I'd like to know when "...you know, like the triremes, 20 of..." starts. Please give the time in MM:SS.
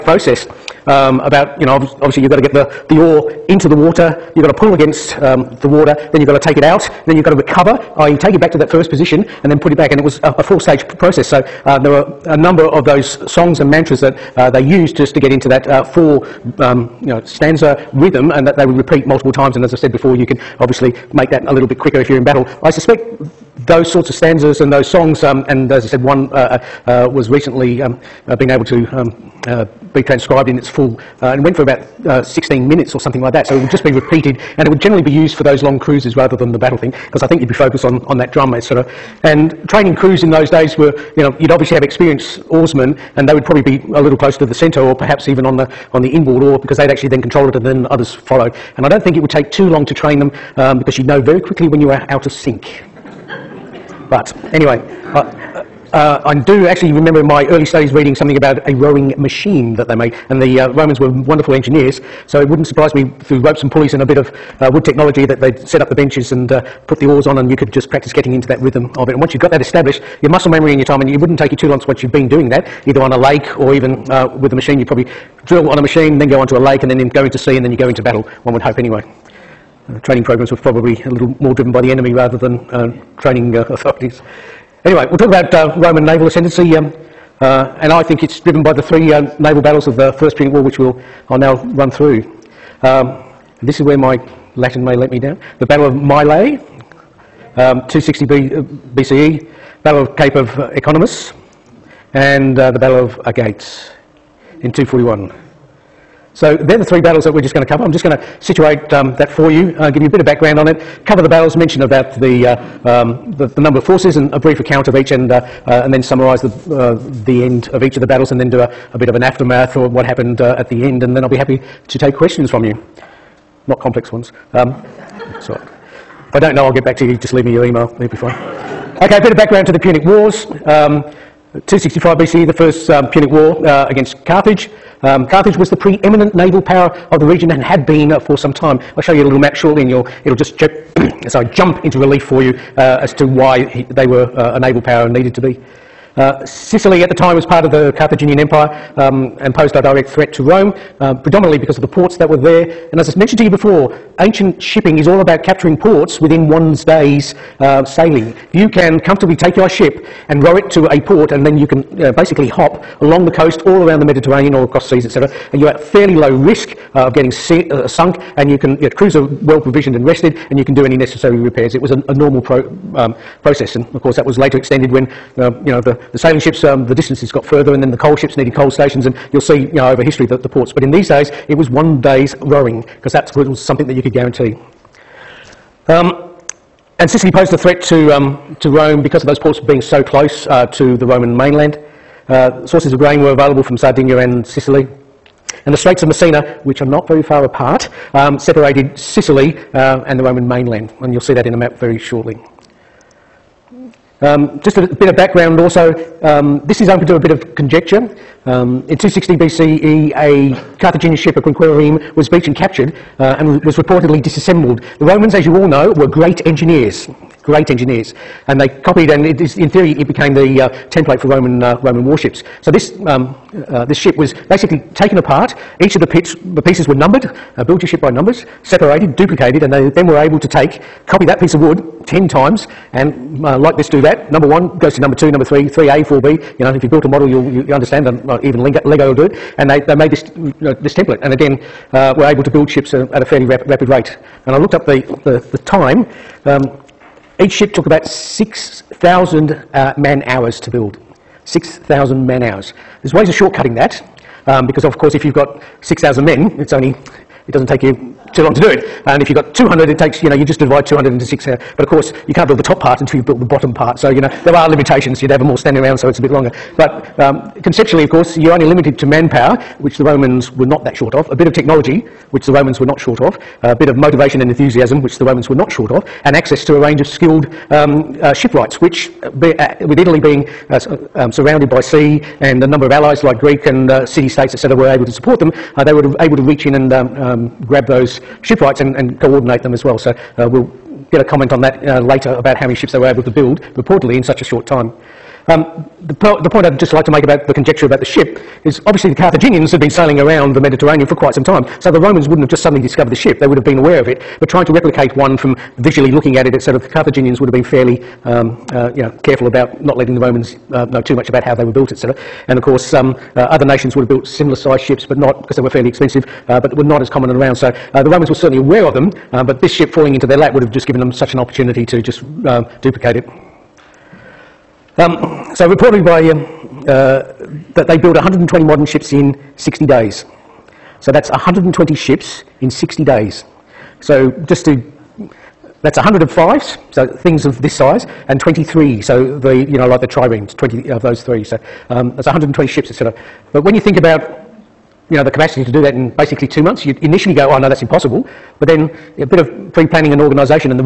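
05:39.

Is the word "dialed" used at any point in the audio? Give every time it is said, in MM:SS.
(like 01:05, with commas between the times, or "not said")
not said.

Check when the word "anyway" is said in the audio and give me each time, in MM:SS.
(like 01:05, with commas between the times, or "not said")
00:54, 01:18, 01:24.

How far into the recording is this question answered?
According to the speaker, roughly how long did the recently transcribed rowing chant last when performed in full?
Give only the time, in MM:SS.
00:32.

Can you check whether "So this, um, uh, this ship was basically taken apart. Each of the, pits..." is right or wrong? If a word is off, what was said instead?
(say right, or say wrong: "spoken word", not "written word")
right.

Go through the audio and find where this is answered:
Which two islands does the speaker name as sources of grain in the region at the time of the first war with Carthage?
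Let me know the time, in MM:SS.
03:13.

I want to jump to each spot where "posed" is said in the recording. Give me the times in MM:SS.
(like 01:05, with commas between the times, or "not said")
02:29, 03:07.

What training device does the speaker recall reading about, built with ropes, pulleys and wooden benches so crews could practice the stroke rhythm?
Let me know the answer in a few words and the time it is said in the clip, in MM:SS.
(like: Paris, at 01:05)
rowing machine, at 00:58.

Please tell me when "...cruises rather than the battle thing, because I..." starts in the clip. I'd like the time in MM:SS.
00:35.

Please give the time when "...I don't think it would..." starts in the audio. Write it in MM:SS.
00:48.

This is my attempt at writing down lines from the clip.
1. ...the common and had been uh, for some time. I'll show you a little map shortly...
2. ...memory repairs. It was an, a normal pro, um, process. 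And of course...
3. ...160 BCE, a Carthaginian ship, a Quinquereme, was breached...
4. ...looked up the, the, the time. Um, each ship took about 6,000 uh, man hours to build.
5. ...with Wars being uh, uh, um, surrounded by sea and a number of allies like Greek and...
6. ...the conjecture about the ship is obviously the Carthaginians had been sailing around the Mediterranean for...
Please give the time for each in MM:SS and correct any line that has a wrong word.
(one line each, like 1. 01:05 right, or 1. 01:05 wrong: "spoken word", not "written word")
1. 02:17 wrong: "region", not "common"
2. 02:50 wrong: "necessary", not "memory"
3. 03:28 wrong: "260", not "160"
4. 04:04 right
5. 04:39 wrong: "Italy", not "Wars"
6. 04:57 right.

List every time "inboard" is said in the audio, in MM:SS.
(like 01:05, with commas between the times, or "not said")
00:46.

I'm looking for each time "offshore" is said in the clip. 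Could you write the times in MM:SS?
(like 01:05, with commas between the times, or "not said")
not said.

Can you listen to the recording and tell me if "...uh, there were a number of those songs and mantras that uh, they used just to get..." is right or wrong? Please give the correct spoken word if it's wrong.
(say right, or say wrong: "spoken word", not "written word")
right.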